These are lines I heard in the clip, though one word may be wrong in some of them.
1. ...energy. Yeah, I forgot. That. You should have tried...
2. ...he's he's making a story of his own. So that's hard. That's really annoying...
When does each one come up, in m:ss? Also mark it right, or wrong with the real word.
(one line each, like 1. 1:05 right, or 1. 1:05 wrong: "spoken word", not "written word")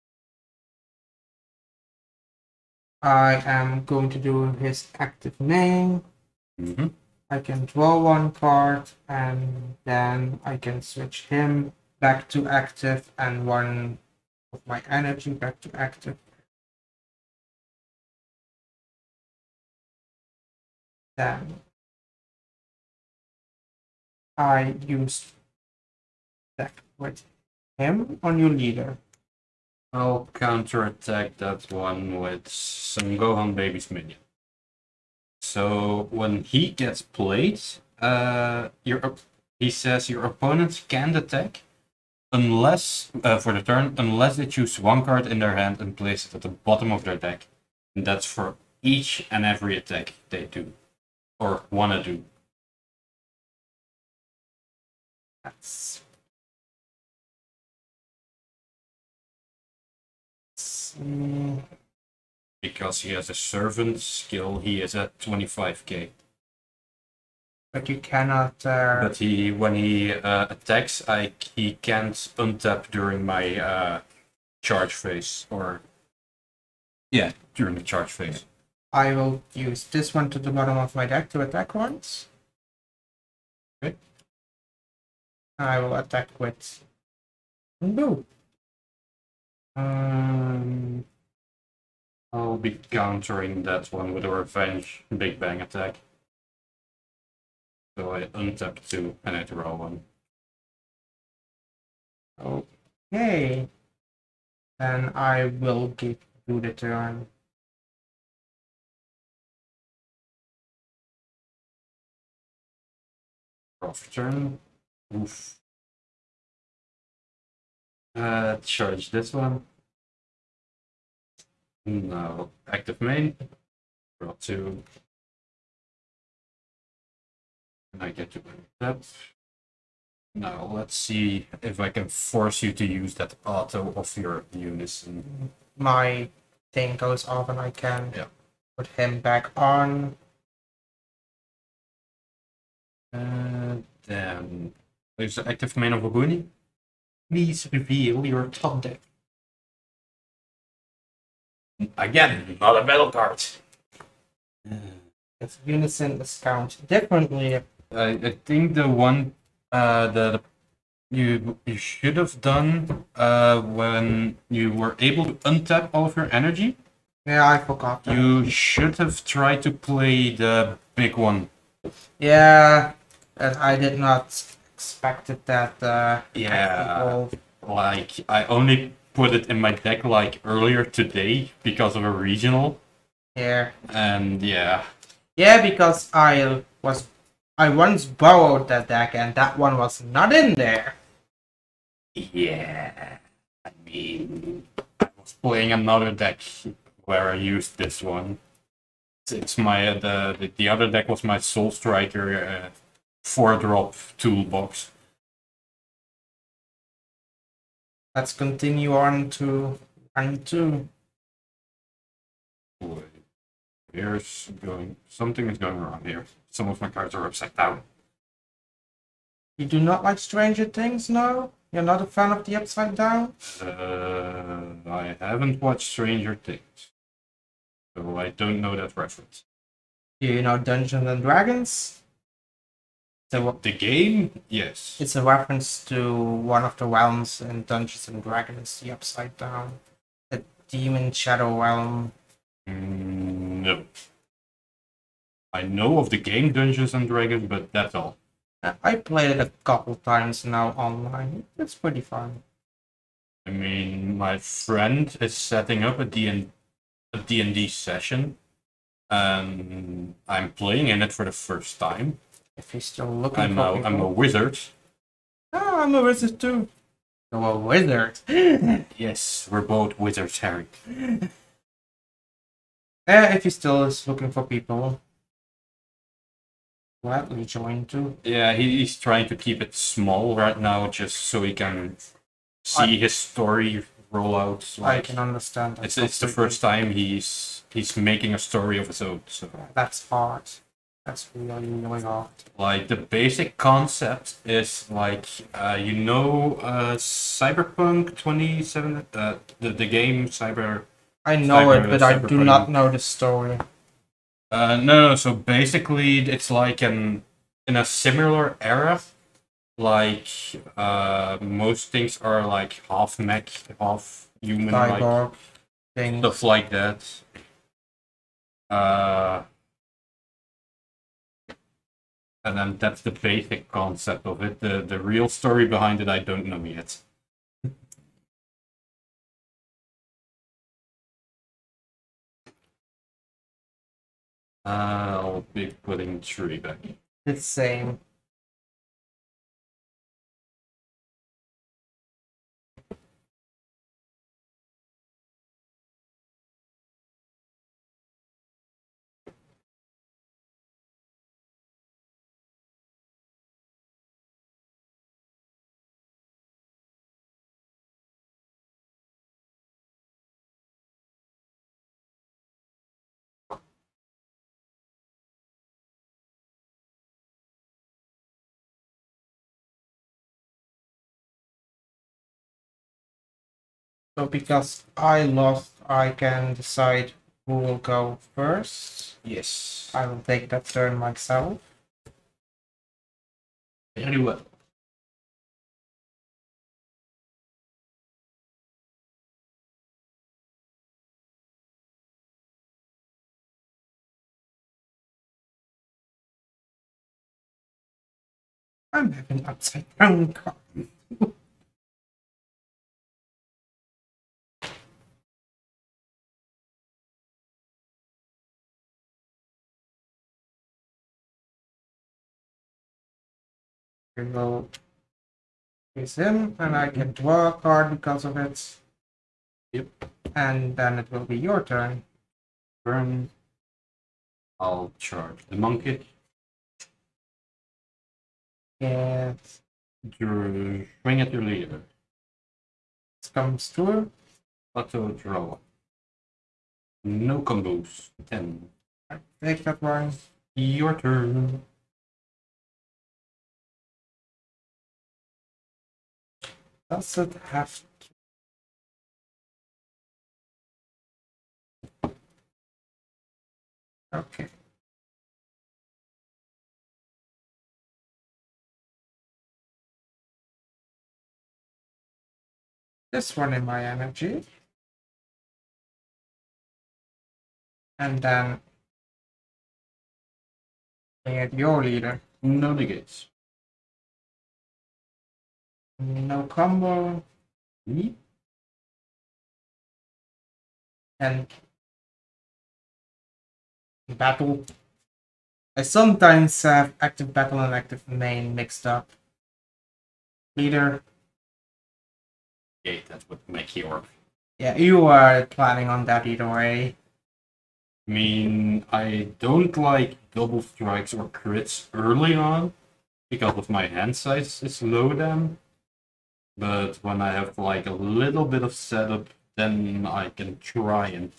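1. 2:46 right
2. 4:46 right.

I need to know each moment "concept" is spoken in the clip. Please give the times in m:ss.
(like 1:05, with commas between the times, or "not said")
4:53, 5:23.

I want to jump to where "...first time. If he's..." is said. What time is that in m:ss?
4:21.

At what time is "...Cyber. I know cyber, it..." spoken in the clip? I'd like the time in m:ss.
5:00.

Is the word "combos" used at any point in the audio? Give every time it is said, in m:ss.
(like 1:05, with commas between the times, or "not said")
7:17, 7:56.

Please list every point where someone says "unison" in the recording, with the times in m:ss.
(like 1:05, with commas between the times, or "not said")
2:14, 2:35.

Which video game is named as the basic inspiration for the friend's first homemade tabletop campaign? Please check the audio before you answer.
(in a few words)
Cyberpunk.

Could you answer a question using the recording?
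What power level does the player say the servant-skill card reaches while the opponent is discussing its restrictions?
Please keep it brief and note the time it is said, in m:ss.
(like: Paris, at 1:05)
25k, at 1:05.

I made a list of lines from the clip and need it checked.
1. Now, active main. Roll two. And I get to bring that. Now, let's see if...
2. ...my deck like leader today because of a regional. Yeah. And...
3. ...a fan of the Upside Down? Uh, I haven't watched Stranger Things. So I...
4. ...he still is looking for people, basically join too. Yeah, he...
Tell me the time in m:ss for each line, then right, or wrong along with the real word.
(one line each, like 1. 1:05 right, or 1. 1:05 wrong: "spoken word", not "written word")
1. 2:01 right
2. 2:59 wrong: "earlier", not "leader"
3. 3:42 right
4. 4:33 wrong: "gladly", not "basically".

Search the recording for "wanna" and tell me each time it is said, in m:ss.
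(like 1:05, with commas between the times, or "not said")
0:51.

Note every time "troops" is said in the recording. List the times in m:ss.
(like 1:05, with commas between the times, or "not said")
not said.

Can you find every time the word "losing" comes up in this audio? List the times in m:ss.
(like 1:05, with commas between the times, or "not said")
not said.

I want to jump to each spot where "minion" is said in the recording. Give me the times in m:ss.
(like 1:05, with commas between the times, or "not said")
0:33.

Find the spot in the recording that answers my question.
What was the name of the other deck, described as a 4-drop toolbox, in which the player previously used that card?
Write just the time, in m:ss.
3:21.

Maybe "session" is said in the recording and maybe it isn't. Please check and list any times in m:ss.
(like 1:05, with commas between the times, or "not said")
4:17.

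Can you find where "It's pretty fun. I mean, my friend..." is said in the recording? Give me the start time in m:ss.
4:11.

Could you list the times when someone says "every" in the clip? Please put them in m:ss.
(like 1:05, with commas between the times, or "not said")
0:49.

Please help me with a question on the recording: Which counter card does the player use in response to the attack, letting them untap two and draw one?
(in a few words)
Revenge Big Bang Attack.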